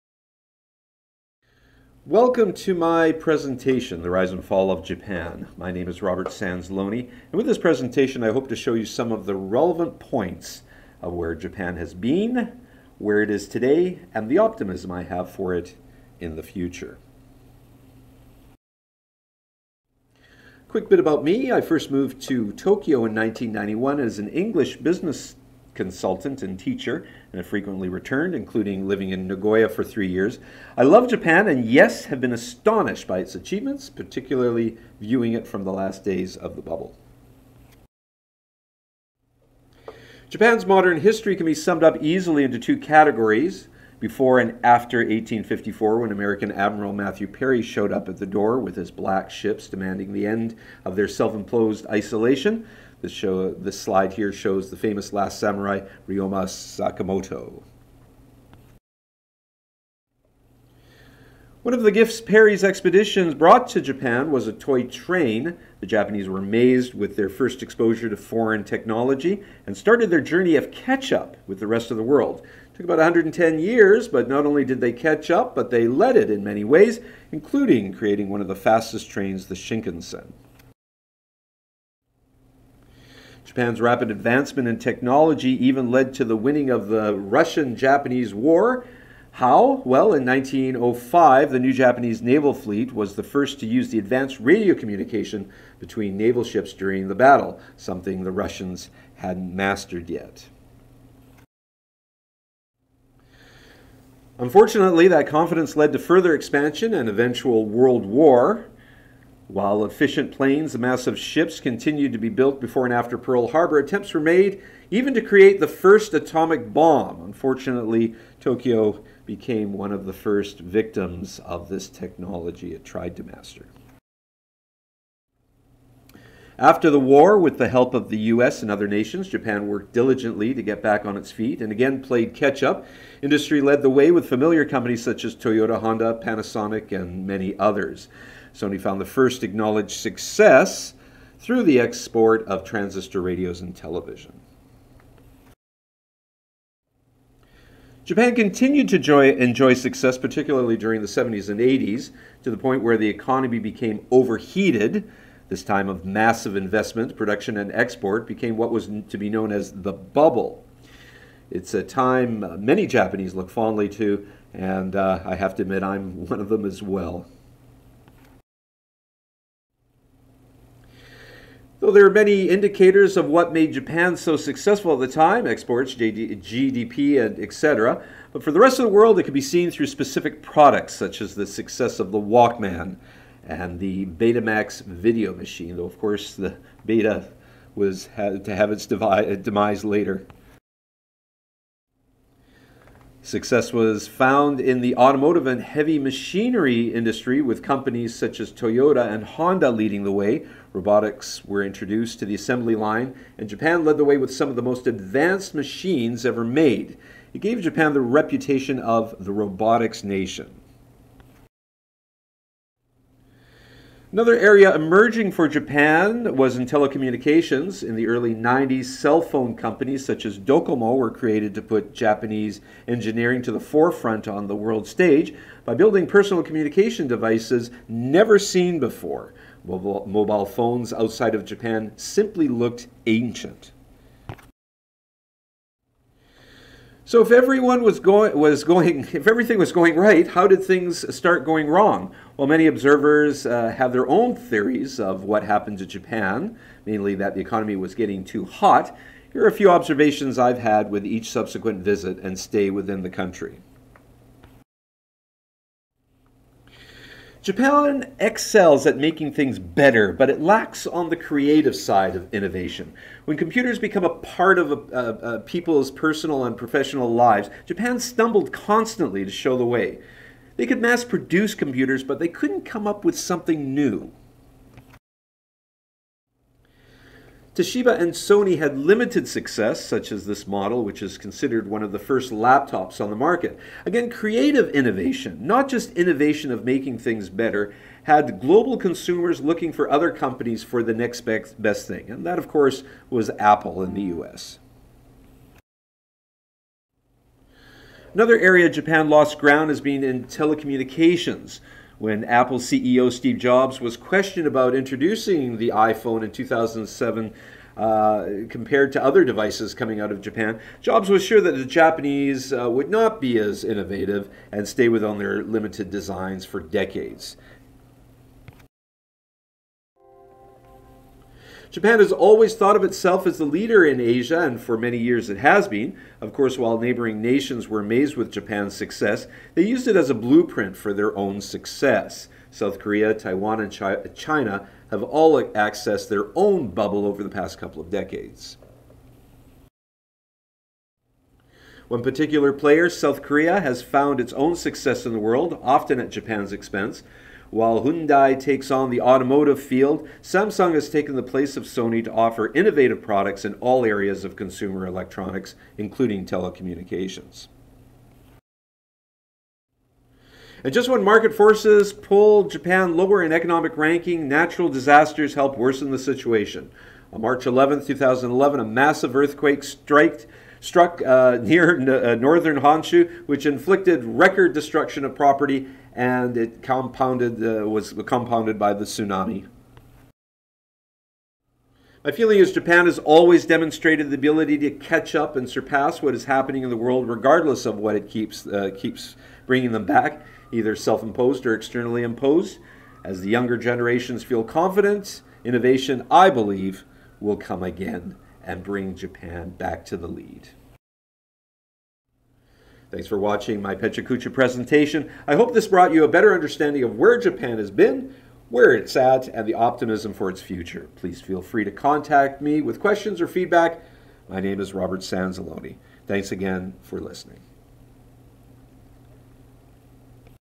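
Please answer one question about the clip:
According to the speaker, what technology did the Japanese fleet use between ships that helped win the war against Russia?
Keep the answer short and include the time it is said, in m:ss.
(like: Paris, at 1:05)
Radio communication, at 1:34.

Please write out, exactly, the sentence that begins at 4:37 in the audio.
Toshiba and Sony had limited success, such as this model, which is considered one of the first laptops on the market.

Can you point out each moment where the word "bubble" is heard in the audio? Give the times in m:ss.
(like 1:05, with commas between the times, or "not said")
0:36, 2:39, 5:36.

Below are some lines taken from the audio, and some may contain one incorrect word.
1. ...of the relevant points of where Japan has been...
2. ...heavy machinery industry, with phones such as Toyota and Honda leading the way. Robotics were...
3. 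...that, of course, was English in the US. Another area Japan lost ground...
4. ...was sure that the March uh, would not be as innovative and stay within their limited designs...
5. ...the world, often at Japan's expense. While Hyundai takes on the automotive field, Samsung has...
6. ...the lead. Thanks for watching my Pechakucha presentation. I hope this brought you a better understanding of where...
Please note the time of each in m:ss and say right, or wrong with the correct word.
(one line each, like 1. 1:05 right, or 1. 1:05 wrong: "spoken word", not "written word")
1. 0:09 right
2. 3:15 wrong: "companies", not "phones"
3. 4:52 wrong: "Apple", not "English"
4. 5:11 wrong: "Japanese", not "March"
5. 5:45 right
6. 6:39 right.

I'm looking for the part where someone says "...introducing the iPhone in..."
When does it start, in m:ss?
5:04.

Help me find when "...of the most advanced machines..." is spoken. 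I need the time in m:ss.
3:24.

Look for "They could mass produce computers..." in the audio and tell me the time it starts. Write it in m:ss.
4:30.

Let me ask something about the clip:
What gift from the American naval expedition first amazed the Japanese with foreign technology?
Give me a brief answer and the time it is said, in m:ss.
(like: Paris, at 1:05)
A toy train, at 1:04.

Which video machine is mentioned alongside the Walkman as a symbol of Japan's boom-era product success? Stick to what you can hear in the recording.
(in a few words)
Betamax.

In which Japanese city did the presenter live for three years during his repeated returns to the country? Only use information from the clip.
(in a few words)
Nagoya.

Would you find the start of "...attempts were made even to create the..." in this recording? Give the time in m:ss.
1:53.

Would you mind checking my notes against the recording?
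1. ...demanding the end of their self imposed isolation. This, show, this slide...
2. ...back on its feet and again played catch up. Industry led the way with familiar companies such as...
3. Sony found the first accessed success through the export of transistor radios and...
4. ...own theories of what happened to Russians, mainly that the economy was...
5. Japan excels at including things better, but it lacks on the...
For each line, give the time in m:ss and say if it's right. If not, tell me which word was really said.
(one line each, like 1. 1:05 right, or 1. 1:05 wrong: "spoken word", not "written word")
1. 0:49 right
2. 2:10 right
3. 2:18 wrong: "acknowledged", not "accessed"
4. 4:04 wrong: "Japan", not "Russians"
5. 4:17 wrong: "making", not "including".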